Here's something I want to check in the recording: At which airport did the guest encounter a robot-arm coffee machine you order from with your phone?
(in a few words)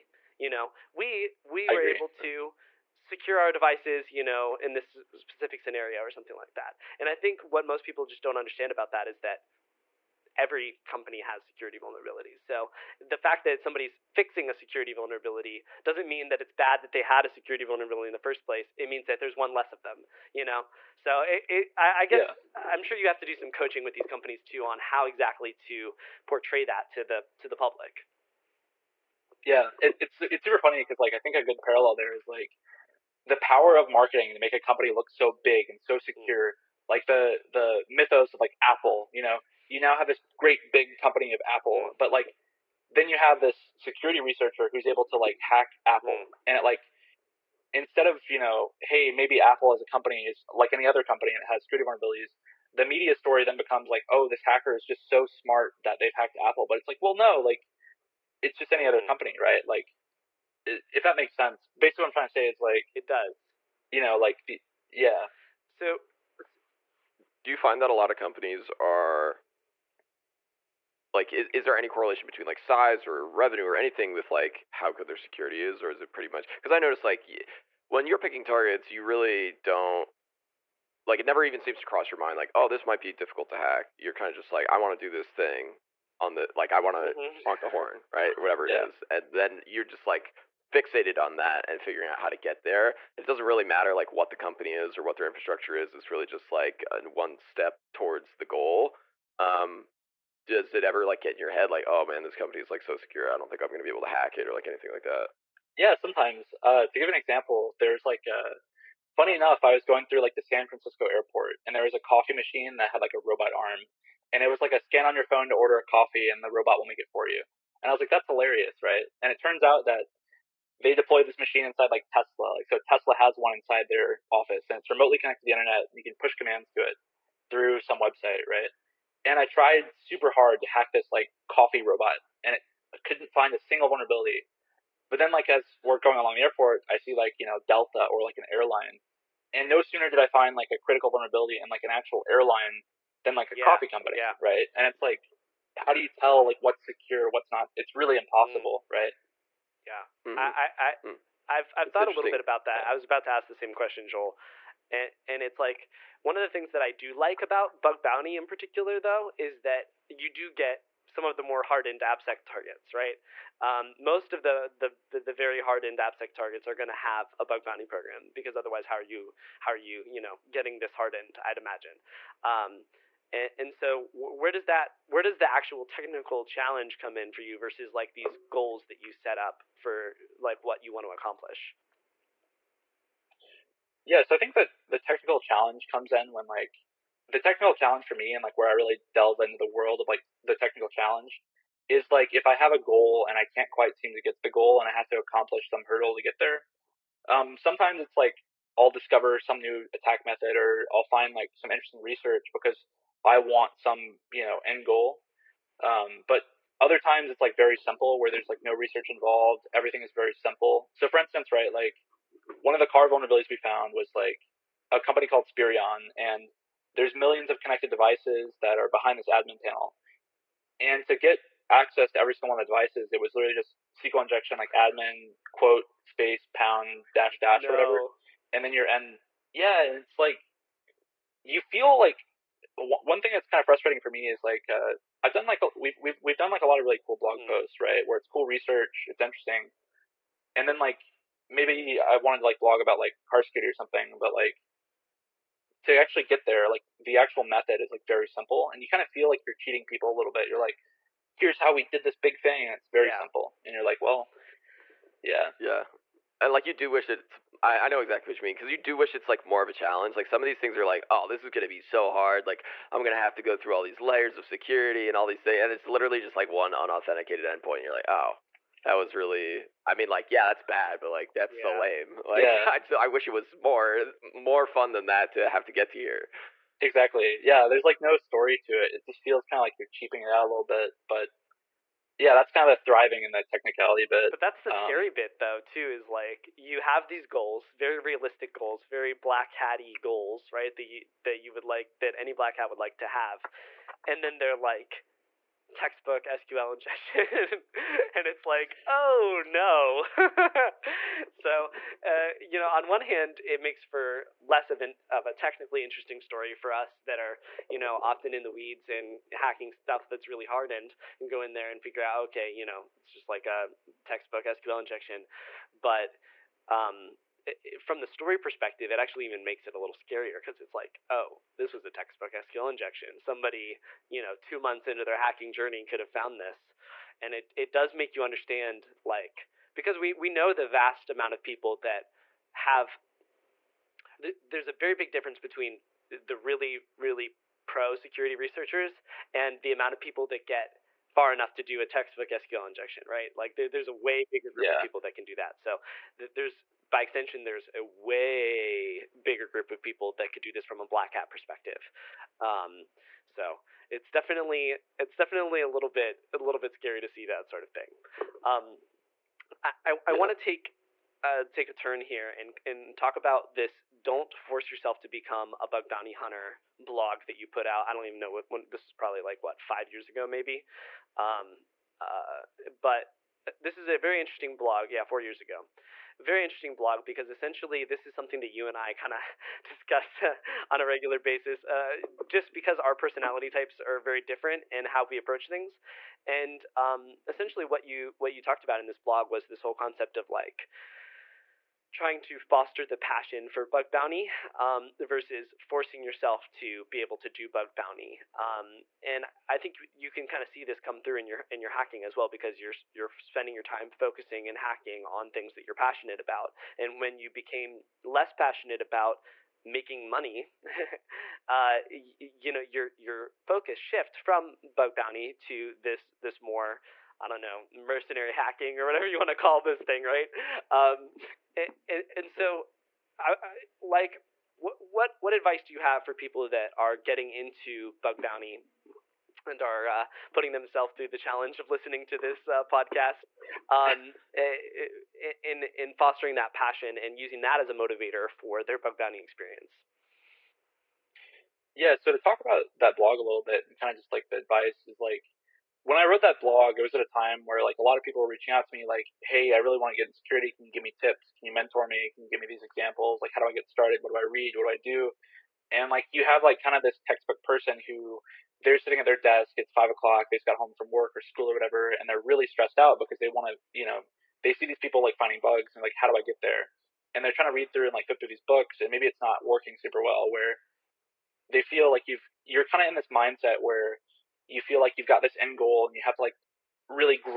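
San Francisco airport.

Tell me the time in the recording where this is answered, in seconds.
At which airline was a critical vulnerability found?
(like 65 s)
137 s.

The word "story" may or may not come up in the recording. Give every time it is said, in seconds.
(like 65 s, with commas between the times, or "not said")
53 s, 278 s, 306 s, 318 s.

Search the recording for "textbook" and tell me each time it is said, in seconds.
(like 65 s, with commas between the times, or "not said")
295 s, 314 s, 321 s, 341 s, 457 s.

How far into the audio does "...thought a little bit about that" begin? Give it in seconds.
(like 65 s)
151 s.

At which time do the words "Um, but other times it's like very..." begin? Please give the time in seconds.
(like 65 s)
205 s.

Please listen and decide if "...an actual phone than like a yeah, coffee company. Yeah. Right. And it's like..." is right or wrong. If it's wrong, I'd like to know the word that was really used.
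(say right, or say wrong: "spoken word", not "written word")
wrong: "airline", not "phone".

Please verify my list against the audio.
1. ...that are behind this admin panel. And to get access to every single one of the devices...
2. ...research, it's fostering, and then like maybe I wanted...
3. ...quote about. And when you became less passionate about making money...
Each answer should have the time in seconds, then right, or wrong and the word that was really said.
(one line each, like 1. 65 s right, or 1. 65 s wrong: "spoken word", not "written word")
1. 218 s right
2. 238 s wrong: "interesting", not "fostering"
3. 405 s wrong: "passionate", not "quote".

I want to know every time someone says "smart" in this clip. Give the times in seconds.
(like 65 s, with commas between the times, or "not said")
55 s.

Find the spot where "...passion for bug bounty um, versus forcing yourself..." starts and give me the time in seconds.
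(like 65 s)
392 s.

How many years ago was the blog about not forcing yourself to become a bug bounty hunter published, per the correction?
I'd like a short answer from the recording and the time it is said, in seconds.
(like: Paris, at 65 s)
4 years, at 375 s.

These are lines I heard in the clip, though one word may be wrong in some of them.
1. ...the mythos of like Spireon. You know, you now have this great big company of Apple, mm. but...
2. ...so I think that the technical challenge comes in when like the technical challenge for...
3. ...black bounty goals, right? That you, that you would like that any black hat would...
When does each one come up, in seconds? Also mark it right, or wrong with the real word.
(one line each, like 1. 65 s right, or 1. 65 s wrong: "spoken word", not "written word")
1. 37 s wrong: "Apple", not "Spireon"
2. 184 s right
3. 289 s wrong: "hatty", not "bounty".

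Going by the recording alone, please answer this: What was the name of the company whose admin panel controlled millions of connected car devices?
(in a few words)
Spireon.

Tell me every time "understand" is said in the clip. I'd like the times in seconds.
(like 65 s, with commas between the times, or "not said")
8 s, 328 s.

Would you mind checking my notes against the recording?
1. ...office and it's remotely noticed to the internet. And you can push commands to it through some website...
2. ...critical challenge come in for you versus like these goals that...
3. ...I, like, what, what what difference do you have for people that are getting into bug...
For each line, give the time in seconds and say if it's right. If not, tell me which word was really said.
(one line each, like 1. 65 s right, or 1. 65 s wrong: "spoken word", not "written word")
1. 124 s wrong: "connected", not "noticed"
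2. 175 s wrong: "technical", not "critical"
3. 423 s wrong: "advice", not "difference".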